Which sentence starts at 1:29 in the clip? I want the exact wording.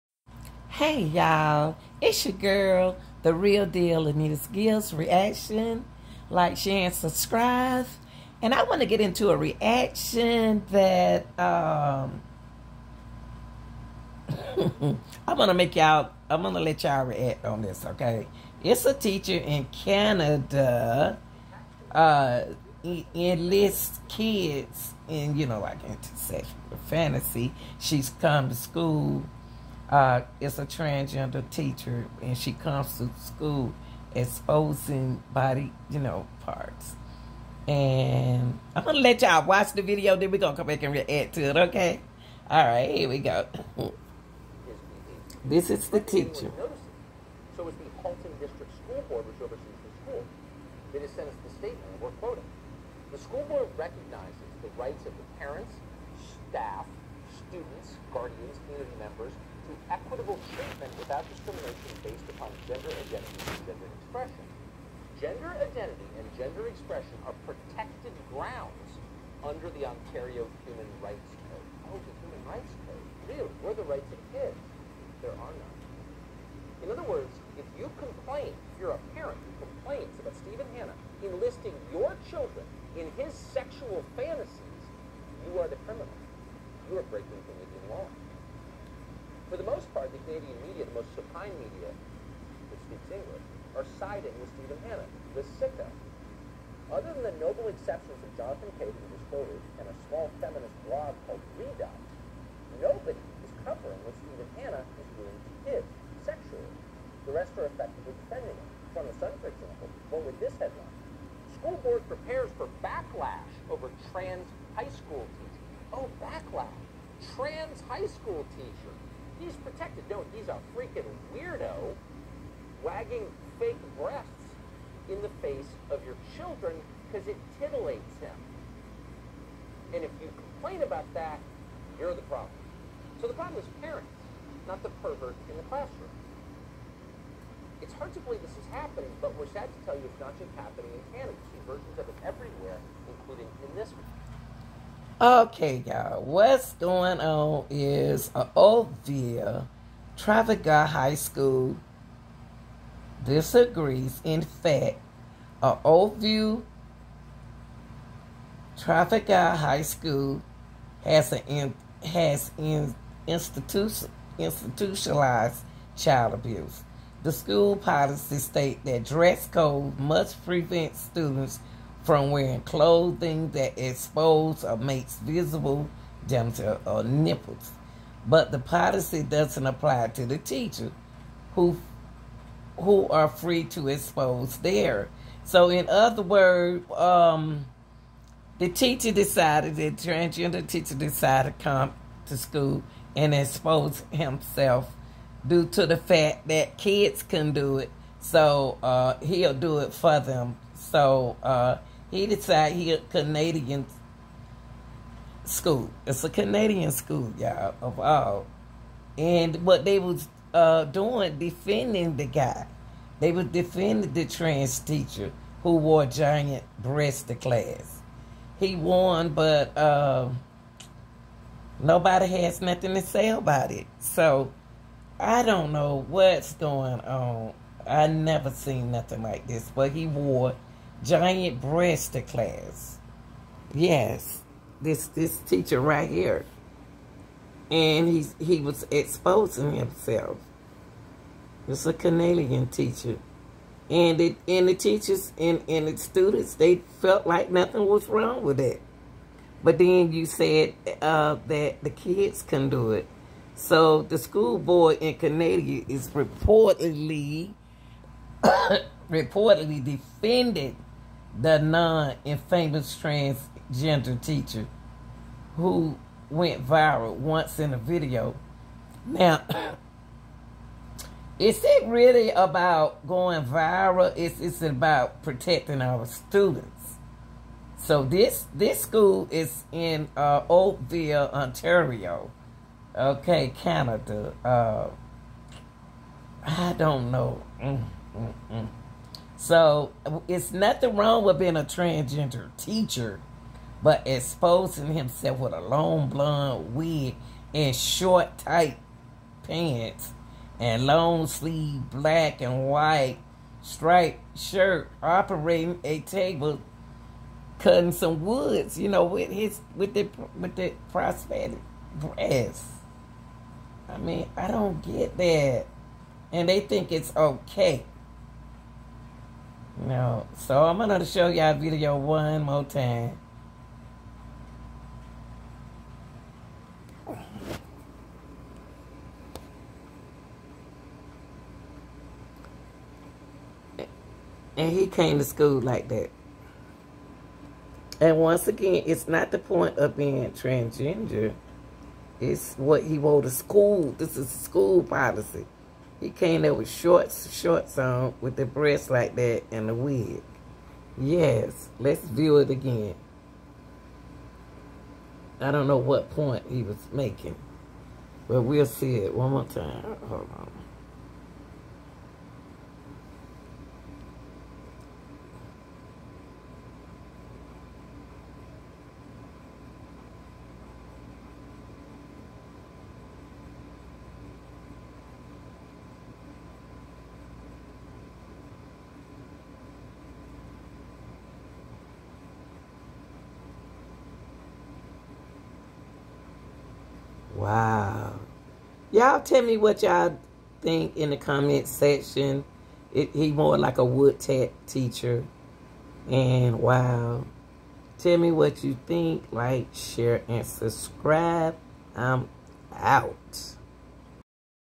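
For the most part, the Canadian media, the most supine media that speaks English, are siding with Stephen Hanna, the sicko.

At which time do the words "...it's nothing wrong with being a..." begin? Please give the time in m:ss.
4:50.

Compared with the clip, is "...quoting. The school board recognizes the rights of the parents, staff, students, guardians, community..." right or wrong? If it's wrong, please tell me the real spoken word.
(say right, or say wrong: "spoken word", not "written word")
right.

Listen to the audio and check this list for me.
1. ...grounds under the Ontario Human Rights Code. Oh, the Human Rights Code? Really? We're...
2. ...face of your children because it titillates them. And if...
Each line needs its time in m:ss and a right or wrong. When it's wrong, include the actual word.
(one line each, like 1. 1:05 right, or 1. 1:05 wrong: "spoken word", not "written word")
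1. 1:08 right
2. 2:05 right.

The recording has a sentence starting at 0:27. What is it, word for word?
She's come to school uh, is a transgender teacher, and she comes to school exposing body, you know, parts.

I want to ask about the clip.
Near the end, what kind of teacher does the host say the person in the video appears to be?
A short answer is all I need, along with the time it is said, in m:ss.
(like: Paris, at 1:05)
Wood tech teacher, at 6:33.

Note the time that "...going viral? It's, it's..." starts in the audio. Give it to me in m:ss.
4:33.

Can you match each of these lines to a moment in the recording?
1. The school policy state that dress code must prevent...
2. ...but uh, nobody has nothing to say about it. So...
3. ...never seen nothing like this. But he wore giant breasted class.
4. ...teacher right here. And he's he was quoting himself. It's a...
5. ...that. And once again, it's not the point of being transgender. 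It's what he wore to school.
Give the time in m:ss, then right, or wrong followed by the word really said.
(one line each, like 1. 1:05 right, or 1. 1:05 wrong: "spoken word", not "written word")
1. 2:47 right
2. 3:39 right
3. 3:48 right
4. 3:55 wrong: "exposing", not "quoting"
5. 5:35 right.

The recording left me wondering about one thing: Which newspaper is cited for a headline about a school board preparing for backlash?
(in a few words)
The Sun.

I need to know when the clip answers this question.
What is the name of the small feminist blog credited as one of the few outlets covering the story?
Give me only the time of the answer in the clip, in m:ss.
1:41.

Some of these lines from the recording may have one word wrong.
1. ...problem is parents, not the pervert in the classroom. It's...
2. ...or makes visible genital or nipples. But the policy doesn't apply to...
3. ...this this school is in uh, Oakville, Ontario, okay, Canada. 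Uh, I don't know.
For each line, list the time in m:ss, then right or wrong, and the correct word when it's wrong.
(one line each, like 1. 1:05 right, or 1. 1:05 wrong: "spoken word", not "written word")
1. 2:13 right
2. 2:54 right
3. 4:38 right.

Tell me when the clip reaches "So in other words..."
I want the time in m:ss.
3:05.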